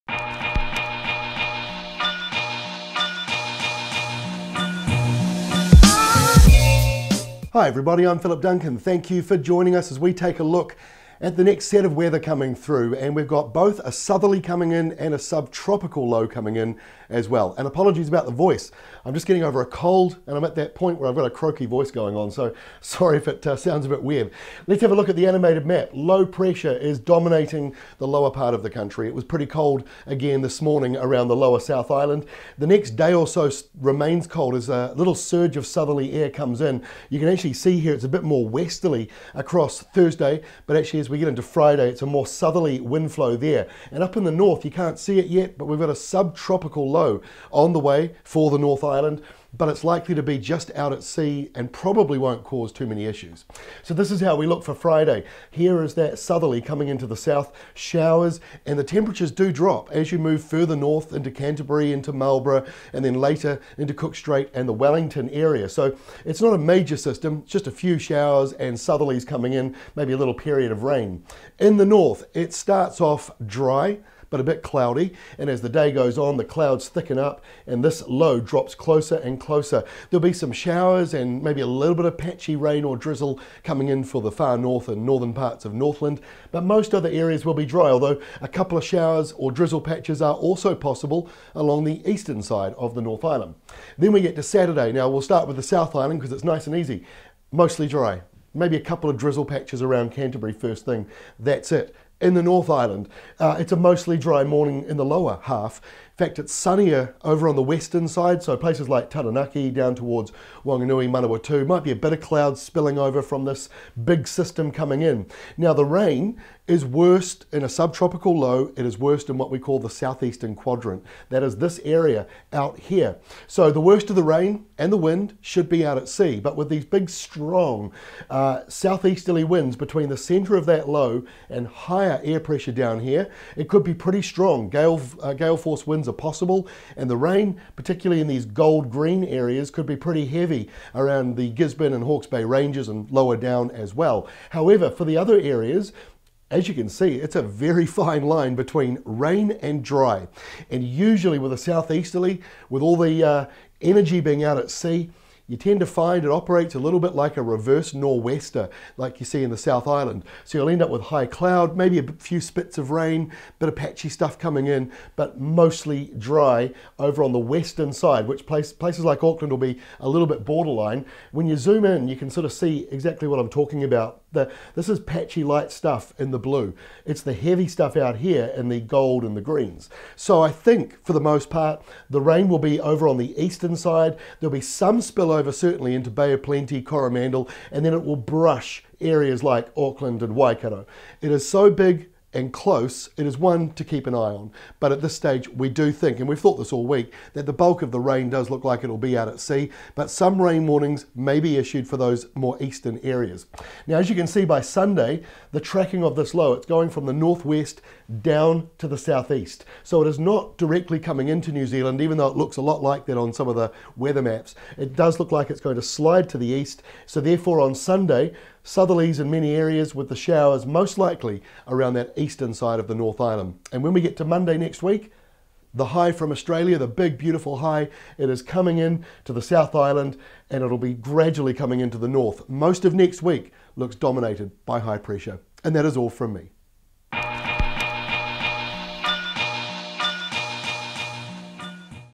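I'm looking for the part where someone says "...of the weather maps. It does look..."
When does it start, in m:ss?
3:33.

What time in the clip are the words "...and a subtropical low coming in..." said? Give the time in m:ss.
0:14.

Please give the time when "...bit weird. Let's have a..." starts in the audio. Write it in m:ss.
0:23.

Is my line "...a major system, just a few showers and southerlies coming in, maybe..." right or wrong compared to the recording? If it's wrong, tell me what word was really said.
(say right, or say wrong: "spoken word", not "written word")
right.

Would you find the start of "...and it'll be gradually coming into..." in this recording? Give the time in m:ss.
3:50.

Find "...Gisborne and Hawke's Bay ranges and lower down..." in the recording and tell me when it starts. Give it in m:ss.
2:21.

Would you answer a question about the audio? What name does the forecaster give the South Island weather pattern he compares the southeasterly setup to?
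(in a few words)
Reverse nor'wester.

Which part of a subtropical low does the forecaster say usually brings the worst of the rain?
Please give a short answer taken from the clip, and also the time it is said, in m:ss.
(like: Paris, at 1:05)
Southeastern quadrant, at 1:59.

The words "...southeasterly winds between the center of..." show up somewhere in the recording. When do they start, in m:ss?
2:08.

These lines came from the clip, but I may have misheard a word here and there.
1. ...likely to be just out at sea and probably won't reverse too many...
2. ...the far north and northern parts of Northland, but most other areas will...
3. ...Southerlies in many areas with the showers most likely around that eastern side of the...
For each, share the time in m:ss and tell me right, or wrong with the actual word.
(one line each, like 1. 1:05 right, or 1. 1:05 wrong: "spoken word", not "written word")
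1. 0:49 wrong: "cause", not "reverse"
2. 1:24 right
3. 3:38 right.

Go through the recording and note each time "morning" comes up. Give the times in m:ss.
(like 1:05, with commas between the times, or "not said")
0:30, 1:44.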